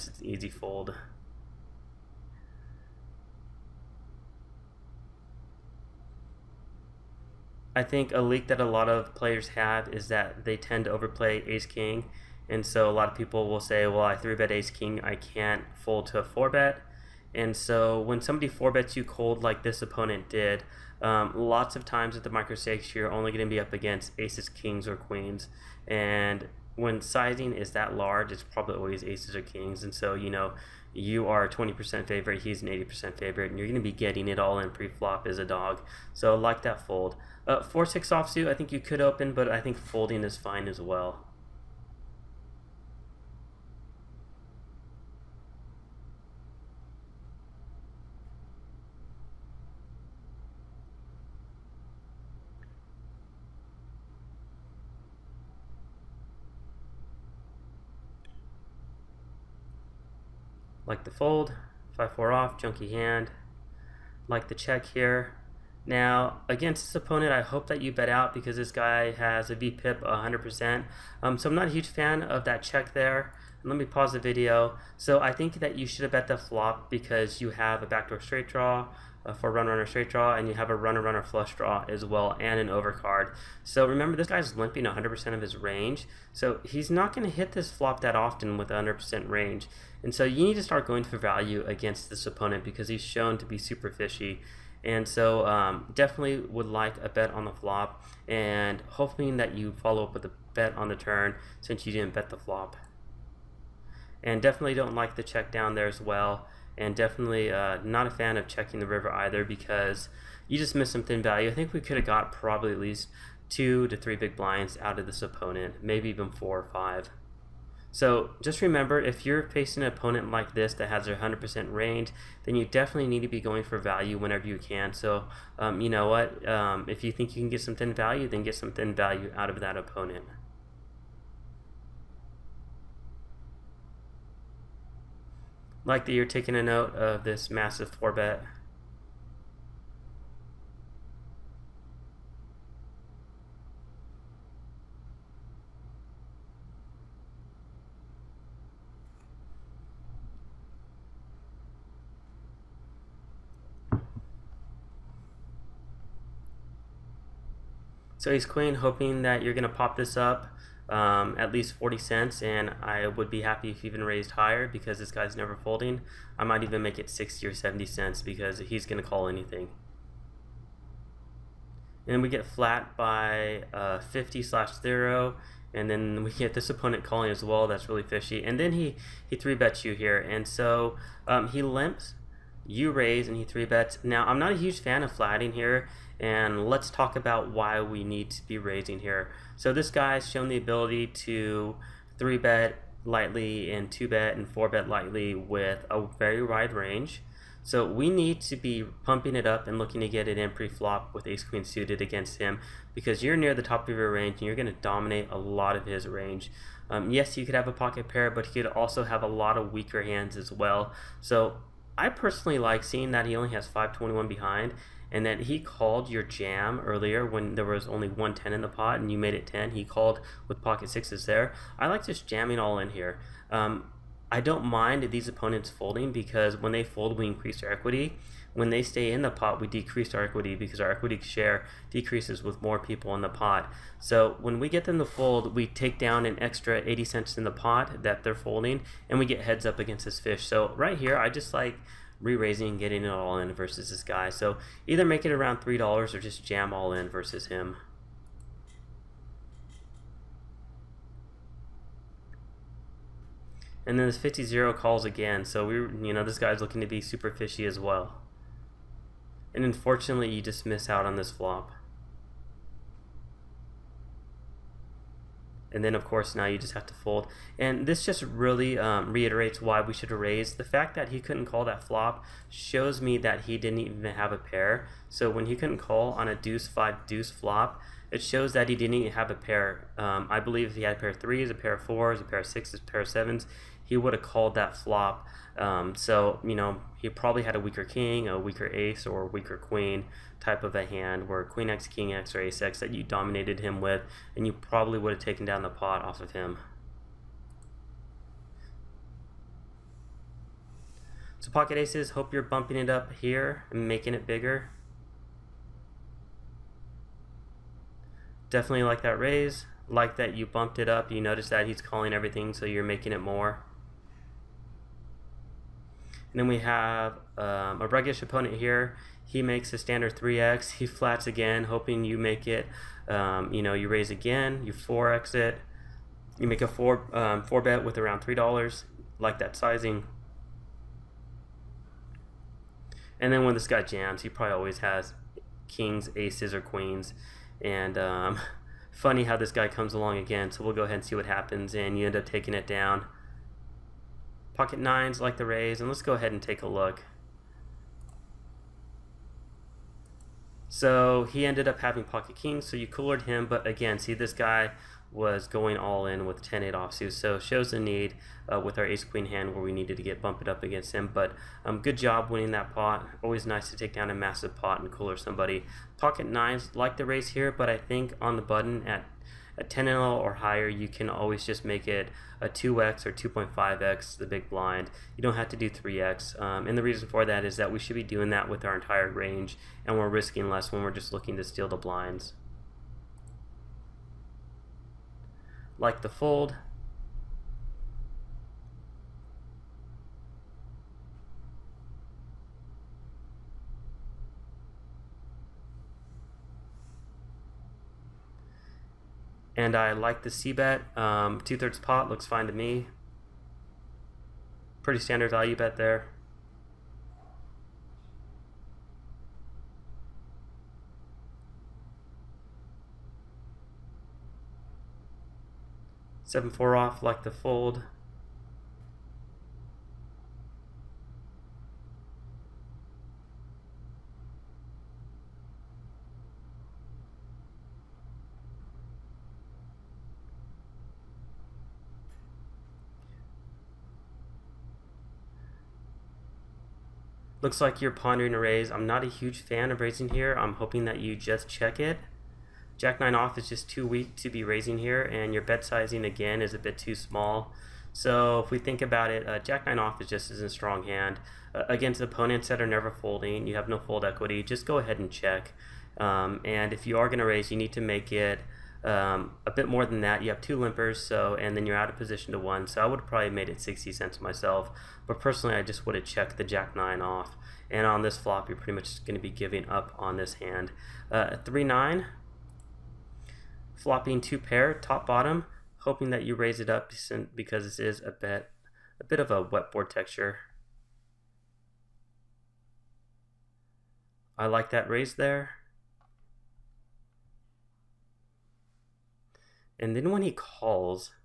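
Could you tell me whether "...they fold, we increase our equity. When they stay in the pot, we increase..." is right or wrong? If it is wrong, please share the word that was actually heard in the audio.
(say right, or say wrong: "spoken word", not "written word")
wrong: "decrease", not "increase".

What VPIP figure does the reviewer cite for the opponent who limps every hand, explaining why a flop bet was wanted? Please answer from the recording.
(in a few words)
100%.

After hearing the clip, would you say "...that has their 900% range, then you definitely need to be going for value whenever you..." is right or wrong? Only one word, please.
wrong.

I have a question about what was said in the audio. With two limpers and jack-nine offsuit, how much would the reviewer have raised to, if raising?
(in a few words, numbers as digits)
60 cents.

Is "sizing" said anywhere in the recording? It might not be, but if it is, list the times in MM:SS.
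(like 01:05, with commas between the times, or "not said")
00:27, 05:29, 07:25.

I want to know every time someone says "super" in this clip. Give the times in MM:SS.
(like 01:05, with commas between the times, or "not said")
01:33, 04:16.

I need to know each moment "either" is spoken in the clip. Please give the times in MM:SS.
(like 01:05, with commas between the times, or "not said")
01:49, 04:04.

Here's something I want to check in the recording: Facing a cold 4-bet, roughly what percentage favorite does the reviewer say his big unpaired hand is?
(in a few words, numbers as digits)
20%.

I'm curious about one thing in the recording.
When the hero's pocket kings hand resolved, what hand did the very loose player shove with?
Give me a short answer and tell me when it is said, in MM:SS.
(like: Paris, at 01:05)
10-8 offsuit, at 05:56.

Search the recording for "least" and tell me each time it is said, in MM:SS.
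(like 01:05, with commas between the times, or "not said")
01:52, 02:41.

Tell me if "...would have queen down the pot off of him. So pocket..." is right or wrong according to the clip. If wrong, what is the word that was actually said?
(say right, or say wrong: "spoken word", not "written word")
wrong: "taken", not "queen".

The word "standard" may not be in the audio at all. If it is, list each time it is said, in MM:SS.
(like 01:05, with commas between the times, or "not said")
05:19, 06:44.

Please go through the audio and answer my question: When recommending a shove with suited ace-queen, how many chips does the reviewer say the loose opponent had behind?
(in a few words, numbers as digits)
521.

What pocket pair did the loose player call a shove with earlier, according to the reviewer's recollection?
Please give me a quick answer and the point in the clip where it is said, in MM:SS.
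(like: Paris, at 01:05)
Pocket sixes, at 03:40.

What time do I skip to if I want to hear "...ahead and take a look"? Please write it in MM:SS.
05:46.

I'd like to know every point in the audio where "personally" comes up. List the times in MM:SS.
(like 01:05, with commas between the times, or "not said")
03:32, 07:45.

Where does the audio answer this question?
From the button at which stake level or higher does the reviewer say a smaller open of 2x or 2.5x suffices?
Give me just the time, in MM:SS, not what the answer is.
06:09.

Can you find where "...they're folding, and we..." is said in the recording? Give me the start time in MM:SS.
03:58.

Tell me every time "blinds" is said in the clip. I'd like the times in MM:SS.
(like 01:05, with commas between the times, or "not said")
01:54, 06:14, 06:21.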